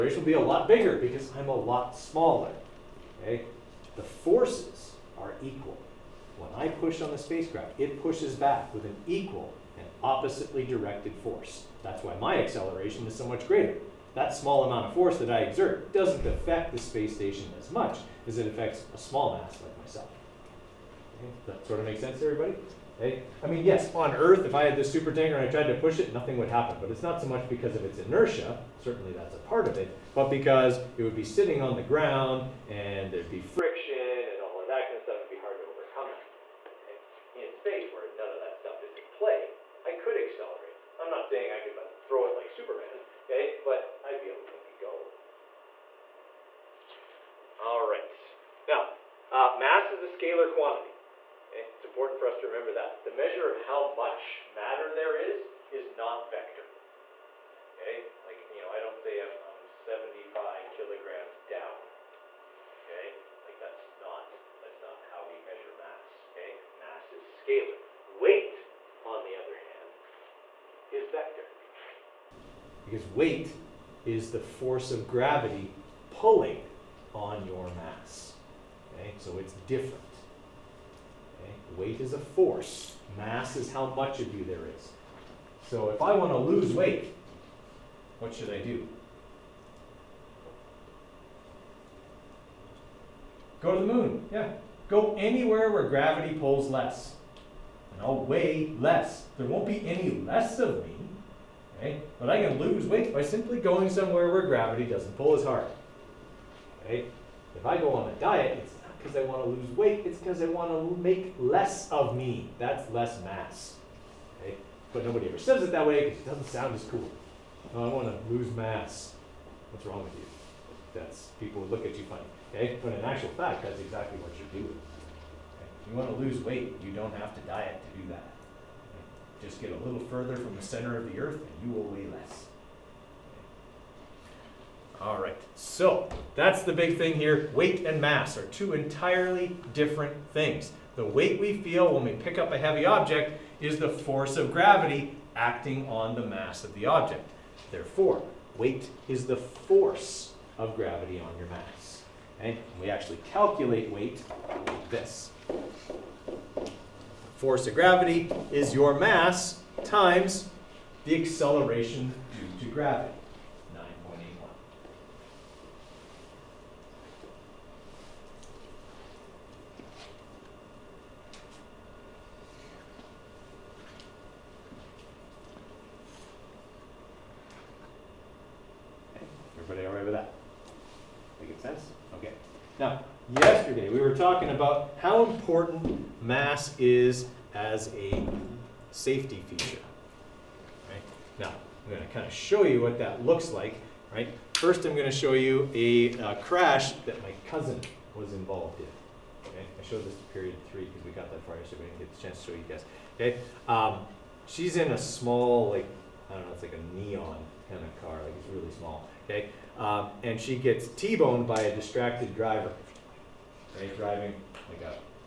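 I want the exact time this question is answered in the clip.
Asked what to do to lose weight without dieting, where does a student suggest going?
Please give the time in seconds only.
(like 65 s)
93 s.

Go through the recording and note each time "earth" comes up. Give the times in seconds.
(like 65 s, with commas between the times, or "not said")
24 s, 131 s.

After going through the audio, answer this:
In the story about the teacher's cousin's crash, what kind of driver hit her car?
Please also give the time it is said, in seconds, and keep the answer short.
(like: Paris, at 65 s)
A distracted driver, at 211 s.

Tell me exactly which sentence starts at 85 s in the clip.
So if I want to lose weight, what should I do?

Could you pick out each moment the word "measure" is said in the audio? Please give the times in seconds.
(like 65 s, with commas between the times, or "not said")
53 s, 65 s.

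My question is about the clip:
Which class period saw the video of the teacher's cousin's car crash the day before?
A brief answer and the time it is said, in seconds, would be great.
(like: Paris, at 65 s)
Period three, at 200 s.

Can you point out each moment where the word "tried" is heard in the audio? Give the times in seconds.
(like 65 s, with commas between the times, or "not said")
25 s.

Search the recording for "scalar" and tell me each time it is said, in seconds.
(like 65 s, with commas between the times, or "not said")
50 s, 67 s.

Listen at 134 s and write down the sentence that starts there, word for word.
All right, so that's the big thing here.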